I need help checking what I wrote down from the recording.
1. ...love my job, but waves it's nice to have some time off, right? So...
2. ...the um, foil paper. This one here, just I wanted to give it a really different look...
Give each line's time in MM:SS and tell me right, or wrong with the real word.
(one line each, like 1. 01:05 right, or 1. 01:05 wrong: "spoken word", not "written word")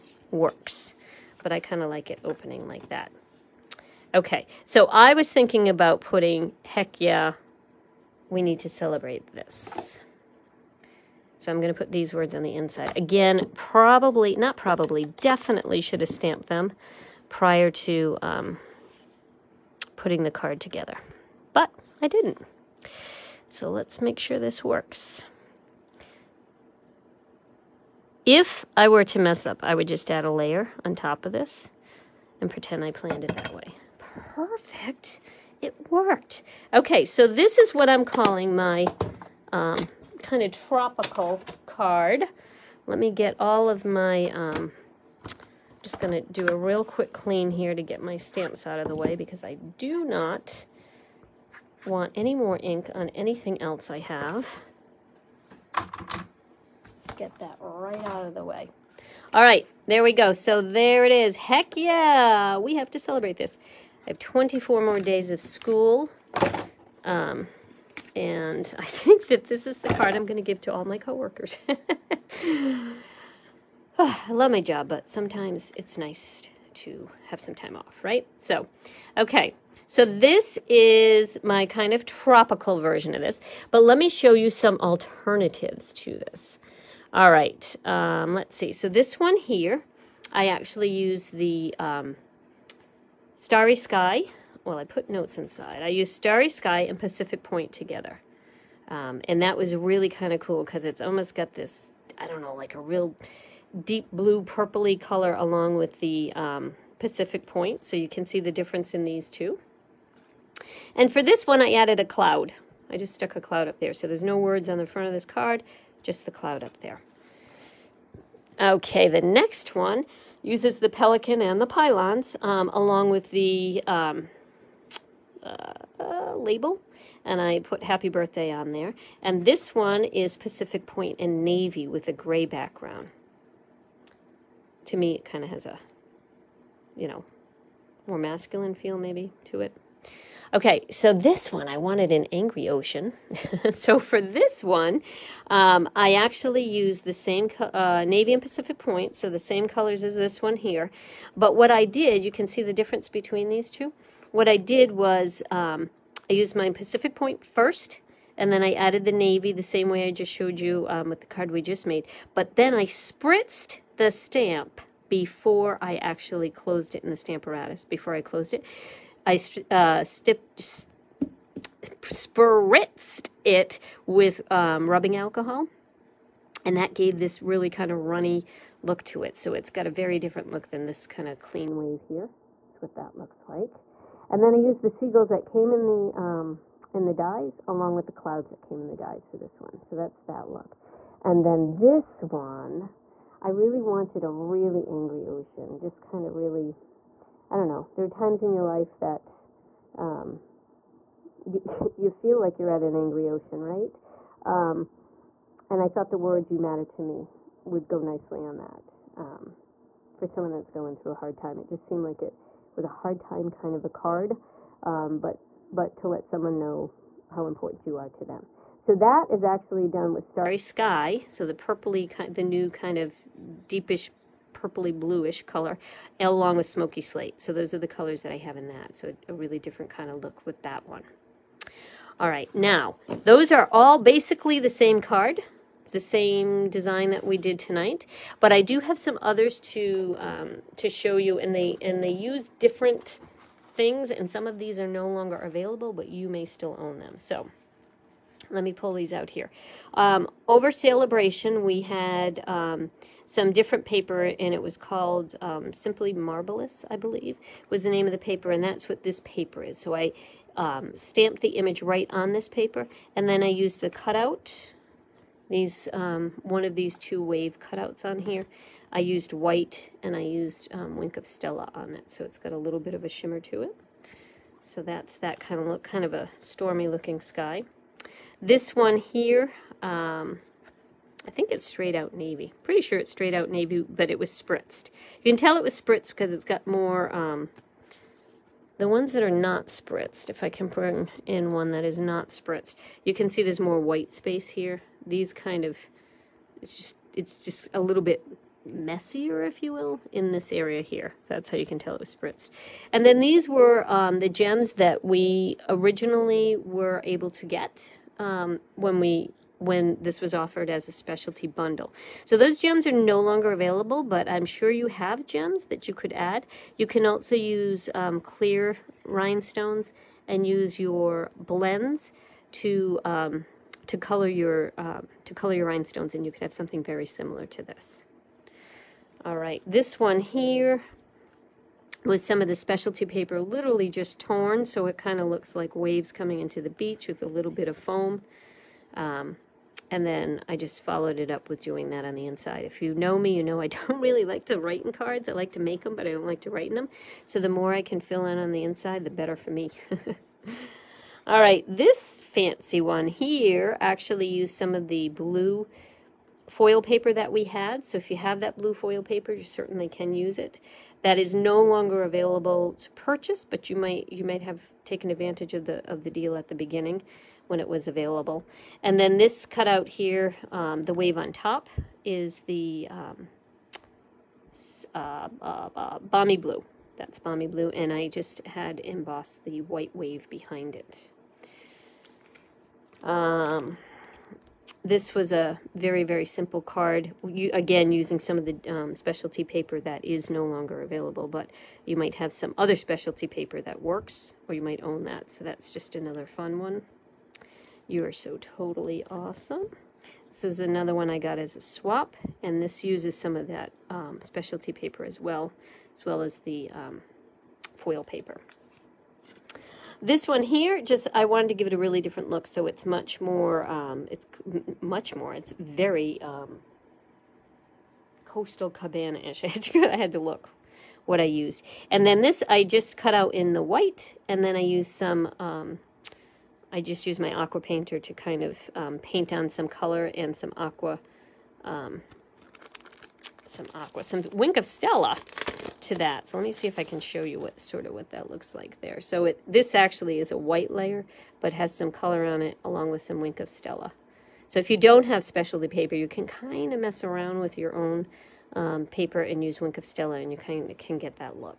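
1. 01:14 wrong: "sometimes", not "waves"
2. 06:46 right.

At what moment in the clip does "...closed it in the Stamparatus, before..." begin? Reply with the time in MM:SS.
02:46.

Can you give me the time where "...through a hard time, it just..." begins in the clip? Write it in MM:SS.
03:30.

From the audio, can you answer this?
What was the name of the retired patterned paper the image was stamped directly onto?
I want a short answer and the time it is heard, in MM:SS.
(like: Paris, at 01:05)
Simply Marvelous, at 04:15.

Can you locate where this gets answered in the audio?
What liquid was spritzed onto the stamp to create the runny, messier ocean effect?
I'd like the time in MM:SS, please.
02:54.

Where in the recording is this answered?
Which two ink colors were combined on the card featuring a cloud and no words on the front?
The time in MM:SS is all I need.
01:36.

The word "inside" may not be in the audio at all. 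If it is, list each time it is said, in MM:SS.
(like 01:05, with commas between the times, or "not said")
00:12, 01:35, 05:42, 05:48.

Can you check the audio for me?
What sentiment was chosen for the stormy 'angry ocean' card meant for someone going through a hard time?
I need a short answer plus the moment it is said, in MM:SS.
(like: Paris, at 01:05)
You matter to me, at 03:26.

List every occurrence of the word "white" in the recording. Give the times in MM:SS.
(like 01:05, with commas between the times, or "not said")
04:29, 04:53, 06:19, 07:03, 07:20.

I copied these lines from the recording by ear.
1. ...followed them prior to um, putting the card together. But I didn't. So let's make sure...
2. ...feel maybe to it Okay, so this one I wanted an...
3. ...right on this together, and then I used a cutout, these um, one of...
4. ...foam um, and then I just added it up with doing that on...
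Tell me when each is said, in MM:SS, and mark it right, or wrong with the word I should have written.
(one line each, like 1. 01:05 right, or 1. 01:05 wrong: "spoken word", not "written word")
1. 00:16 wrong: "stamped", not "followed"
2. 02:18 right
3. 04:21 wrong: "paper", not "together"
4. 05:37 wrong: "followed", not "added".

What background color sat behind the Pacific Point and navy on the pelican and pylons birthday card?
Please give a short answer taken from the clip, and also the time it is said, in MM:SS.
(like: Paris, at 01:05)
Gray, at 02:12.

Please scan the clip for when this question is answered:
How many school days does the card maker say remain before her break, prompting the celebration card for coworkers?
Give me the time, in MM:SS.
01:04.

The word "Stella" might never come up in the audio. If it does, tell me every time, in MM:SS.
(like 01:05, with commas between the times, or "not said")
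04:31, 07:14, 07:23, 07:29.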